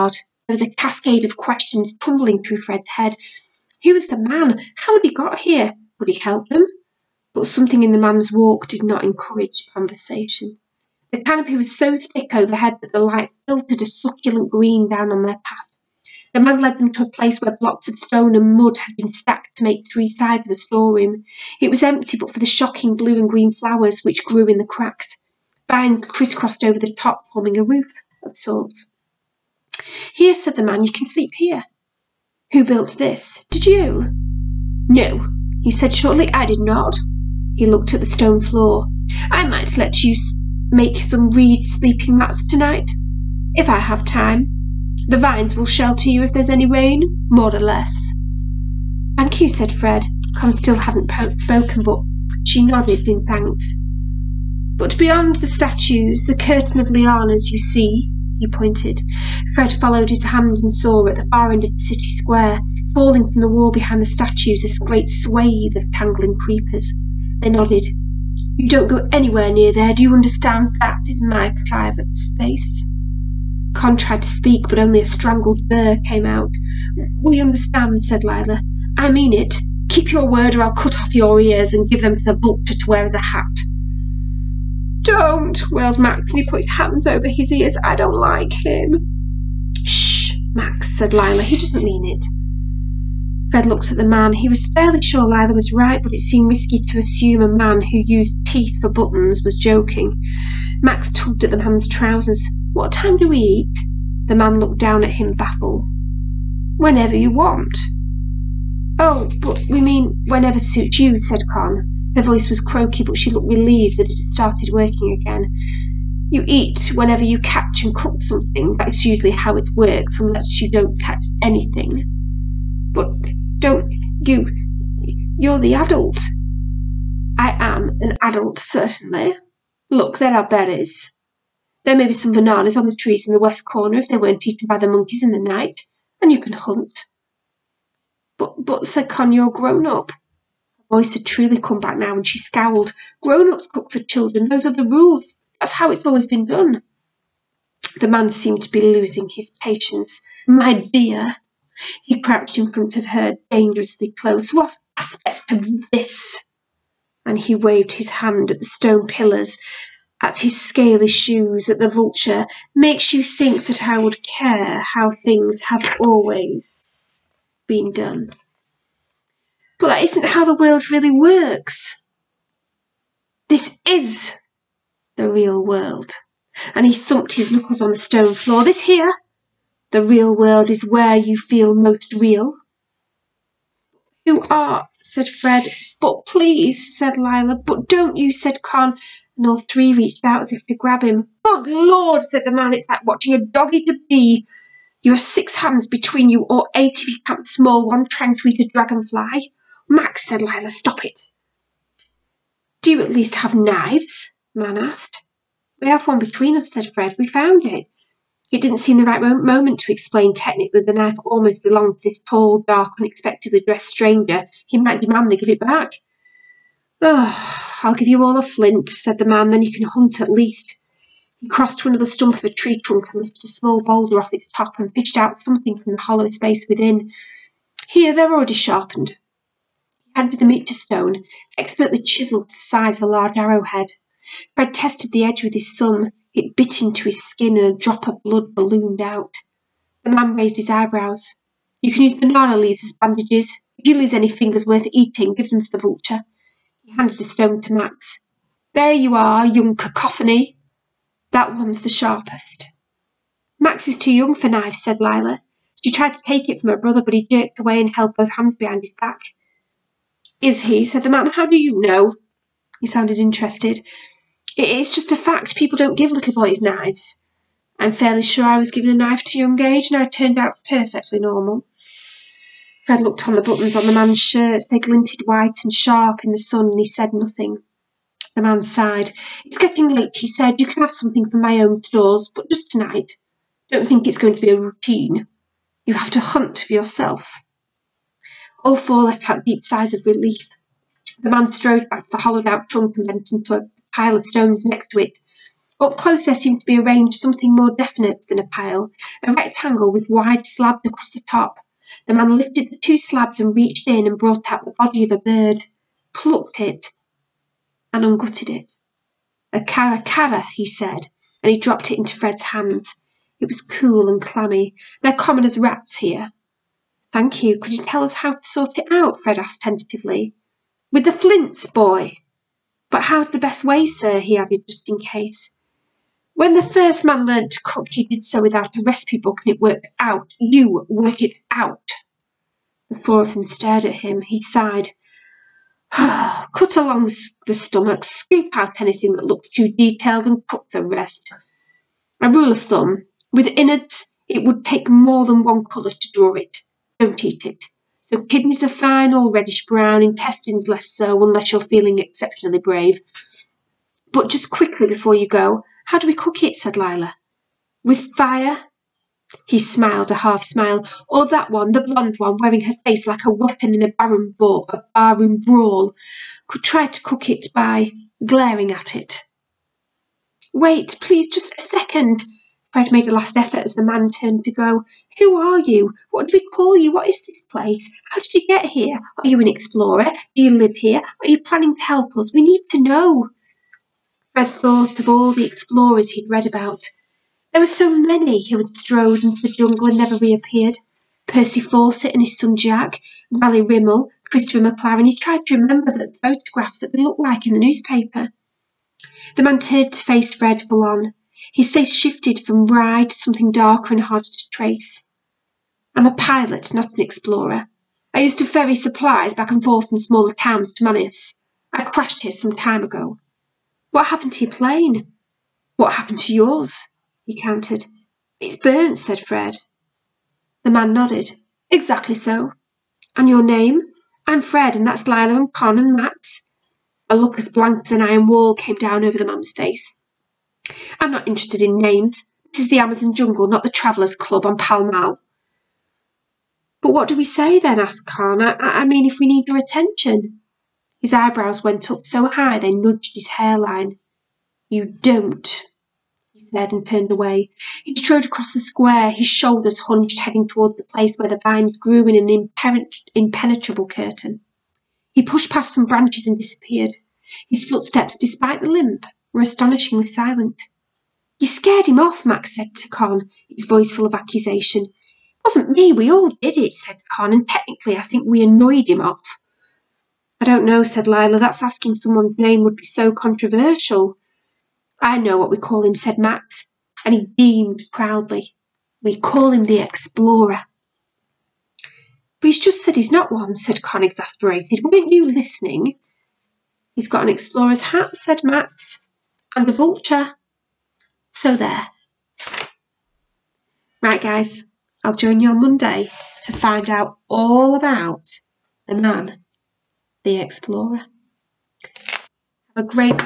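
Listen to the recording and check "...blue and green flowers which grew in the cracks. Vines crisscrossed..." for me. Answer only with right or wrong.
right.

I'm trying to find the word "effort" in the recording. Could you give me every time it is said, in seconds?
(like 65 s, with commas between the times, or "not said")
373 s.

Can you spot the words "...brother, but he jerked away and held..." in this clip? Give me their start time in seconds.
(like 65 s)
256 s.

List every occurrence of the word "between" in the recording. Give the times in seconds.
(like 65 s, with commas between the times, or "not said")
195 s, 206 s.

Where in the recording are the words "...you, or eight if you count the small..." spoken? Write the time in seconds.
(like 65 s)
196 s.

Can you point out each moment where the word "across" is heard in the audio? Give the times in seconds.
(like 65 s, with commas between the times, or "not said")
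300 s, 448 s.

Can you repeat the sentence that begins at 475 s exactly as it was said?
I know what we call him, said Max, and he beamed proudly.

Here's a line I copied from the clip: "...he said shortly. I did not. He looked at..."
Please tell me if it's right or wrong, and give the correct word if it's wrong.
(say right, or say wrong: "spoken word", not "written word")
right.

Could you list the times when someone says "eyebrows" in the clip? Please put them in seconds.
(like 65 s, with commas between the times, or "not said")
240 s, 441 s.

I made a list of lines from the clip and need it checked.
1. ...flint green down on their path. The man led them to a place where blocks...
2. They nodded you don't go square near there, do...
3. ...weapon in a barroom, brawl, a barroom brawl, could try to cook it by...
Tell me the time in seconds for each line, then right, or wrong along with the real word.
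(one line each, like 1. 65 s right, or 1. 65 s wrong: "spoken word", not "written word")
1. 13 s wrong: "succulent", not "flint"
2. 67 s wrong: "anywhere", not "square"
3. 363 s right.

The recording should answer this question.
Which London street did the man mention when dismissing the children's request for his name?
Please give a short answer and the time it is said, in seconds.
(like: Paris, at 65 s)
Pall Mall, at 434 s.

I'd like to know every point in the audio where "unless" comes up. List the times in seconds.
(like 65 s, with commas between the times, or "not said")
120 s, 351 s.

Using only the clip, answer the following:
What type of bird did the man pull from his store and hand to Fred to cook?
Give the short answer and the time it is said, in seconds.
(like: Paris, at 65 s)
caracara, at 309 s.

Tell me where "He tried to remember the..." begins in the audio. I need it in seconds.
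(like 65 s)
395 s.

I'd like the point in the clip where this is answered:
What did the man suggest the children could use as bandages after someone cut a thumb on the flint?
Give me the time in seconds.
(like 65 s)
242 s.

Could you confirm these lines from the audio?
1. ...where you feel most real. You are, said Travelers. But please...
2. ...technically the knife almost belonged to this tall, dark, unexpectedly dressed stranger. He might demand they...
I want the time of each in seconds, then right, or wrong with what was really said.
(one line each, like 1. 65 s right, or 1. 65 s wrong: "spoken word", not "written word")
1. 180 s wrong: "Fred", not "Travelers"
2. 210 s right.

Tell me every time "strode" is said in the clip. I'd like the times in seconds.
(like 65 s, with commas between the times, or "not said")
291 s, 388 s, 447 s.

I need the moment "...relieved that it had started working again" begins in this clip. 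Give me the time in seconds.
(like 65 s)
113 s.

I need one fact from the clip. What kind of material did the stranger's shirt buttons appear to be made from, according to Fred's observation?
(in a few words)
teeth.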